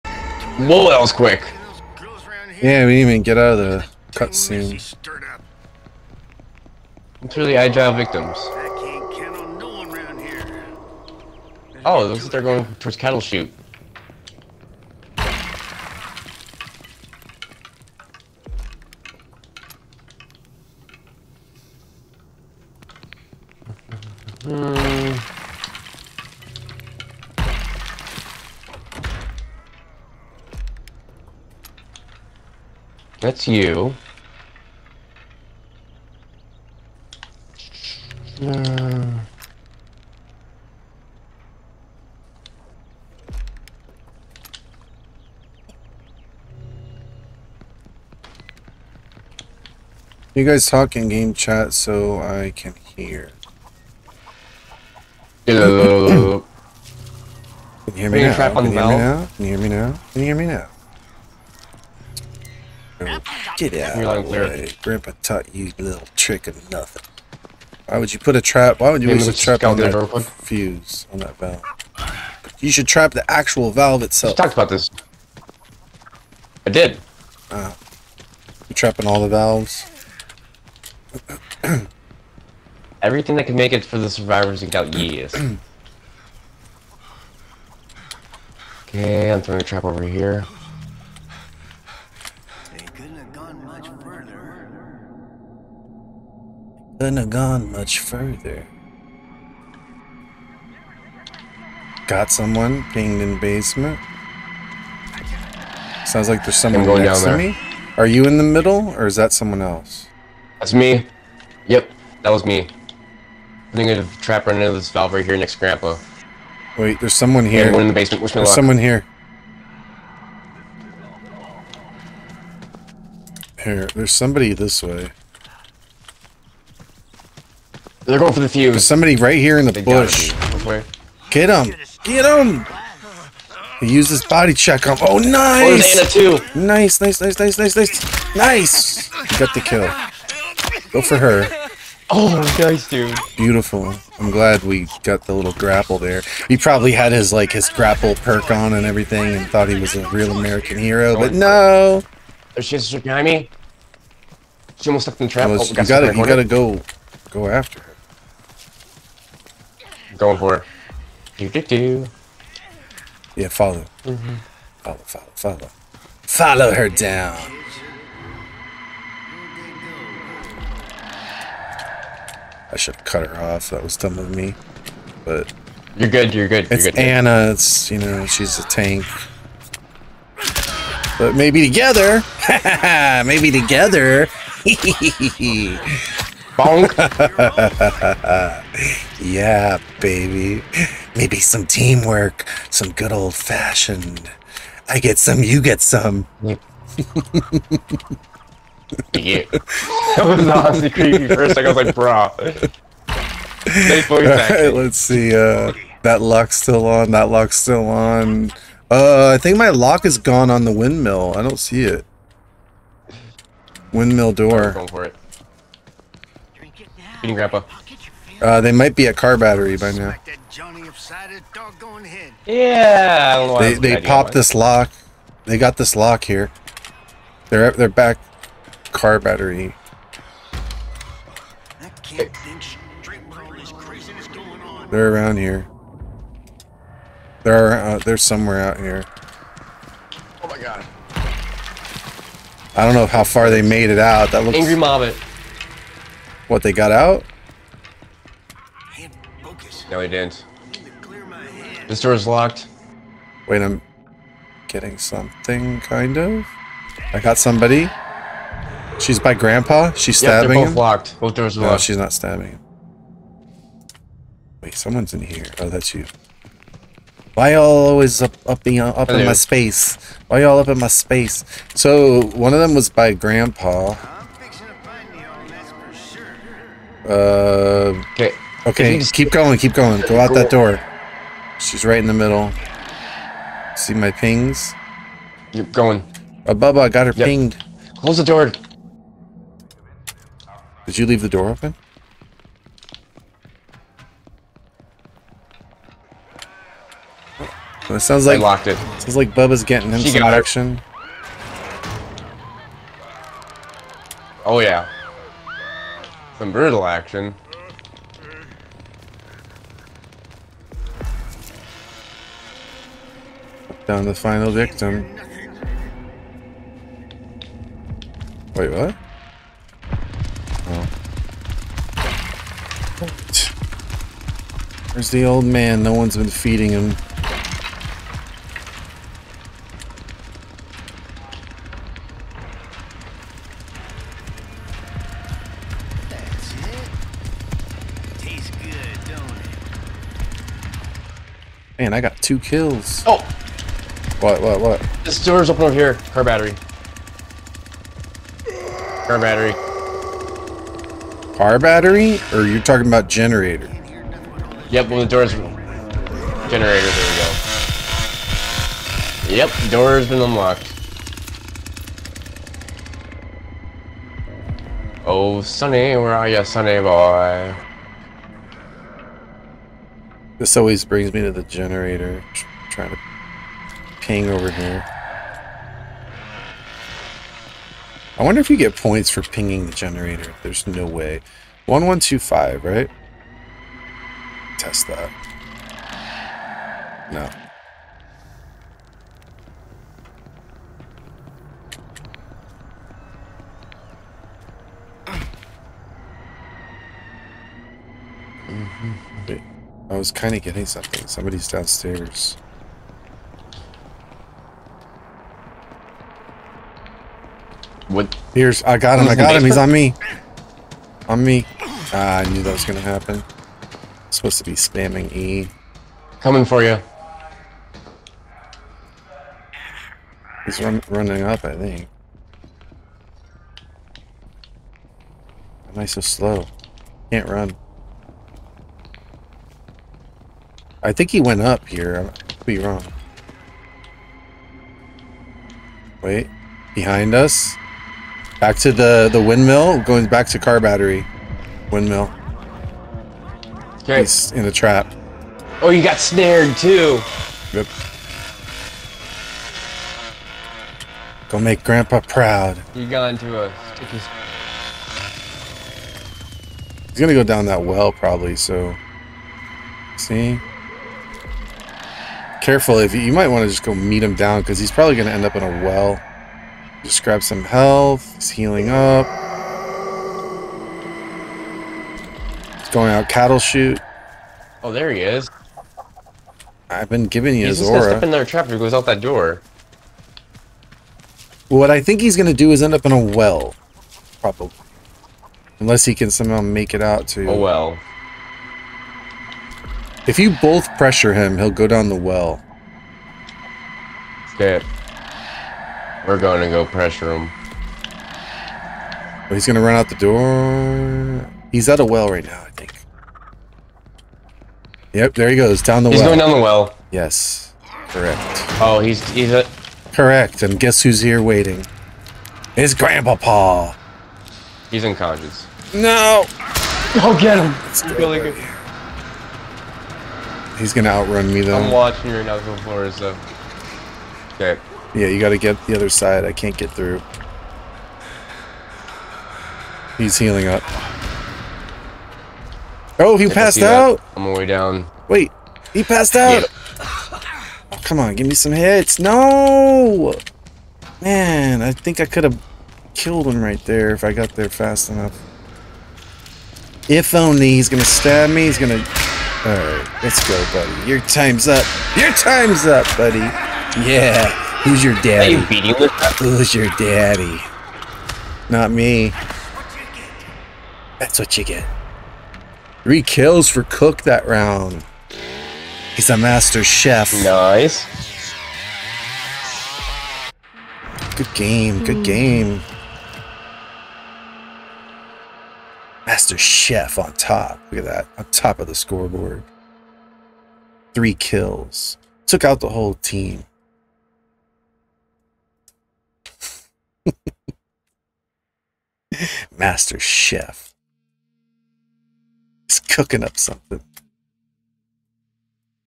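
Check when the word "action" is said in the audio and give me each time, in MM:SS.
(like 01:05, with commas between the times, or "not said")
05:00, 05:06.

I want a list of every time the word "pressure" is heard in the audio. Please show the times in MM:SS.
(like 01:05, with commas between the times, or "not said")
08:10, 08:16.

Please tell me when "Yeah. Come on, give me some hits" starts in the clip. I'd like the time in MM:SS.
08:56.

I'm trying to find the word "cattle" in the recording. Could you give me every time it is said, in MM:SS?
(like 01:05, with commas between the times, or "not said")
00:12, 07:53.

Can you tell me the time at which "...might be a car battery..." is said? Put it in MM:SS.
03:38.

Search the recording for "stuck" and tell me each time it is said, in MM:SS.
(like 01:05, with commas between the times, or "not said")
02:35.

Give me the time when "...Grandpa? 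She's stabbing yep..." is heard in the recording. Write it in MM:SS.
04:19.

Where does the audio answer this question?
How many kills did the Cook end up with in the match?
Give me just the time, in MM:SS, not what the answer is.
09:22.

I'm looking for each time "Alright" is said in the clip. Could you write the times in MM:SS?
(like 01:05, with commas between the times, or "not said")
09:09.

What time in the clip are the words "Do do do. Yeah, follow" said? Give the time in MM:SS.
02:41.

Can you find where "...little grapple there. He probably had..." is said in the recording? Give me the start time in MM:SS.
02:25.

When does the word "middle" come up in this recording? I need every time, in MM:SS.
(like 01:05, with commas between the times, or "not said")
01:48, 04:42.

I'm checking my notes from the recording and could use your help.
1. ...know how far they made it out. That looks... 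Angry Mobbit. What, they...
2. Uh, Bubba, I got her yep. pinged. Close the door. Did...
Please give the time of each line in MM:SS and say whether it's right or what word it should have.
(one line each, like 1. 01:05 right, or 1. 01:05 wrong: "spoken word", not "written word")
1. 04:02 right
2. 04:46 right.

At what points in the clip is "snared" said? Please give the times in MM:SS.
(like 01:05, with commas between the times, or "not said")
07:25.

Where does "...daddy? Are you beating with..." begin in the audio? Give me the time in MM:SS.
09:15.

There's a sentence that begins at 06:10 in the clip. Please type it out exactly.
This always brings me to the generator.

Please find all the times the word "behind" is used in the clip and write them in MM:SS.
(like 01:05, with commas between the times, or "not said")
02:33, 07:16.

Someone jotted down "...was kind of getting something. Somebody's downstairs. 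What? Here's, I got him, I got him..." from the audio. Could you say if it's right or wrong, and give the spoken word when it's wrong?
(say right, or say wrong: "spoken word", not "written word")
right.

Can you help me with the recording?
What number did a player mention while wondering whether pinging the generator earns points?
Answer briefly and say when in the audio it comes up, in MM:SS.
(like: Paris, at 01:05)
1125, at 06:21.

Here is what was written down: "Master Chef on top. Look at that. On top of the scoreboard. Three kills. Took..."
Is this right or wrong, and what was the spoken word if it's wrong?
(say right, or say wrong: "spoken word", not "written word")
right.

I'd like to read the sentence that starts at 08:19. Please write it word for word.
Oh, he's going to run out the door.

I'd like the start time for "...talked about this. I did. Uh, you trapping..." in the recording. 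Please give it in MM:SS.
01:14.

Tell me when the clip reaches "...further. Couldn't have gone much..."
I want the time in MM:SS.
01:34.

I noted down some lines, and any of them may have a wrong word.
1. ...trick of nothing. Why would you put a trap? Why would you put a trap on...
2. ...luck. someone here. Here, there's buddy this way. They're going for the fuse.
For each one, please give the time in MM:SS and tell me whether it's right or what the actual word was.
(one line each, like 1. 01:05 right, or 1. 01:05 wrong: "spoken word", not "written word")
1. 01:06 right
2. 01:58 wrong: "somebody", not "buddy".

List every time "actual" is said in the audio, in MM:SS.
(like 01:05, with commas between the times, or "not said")
01:13.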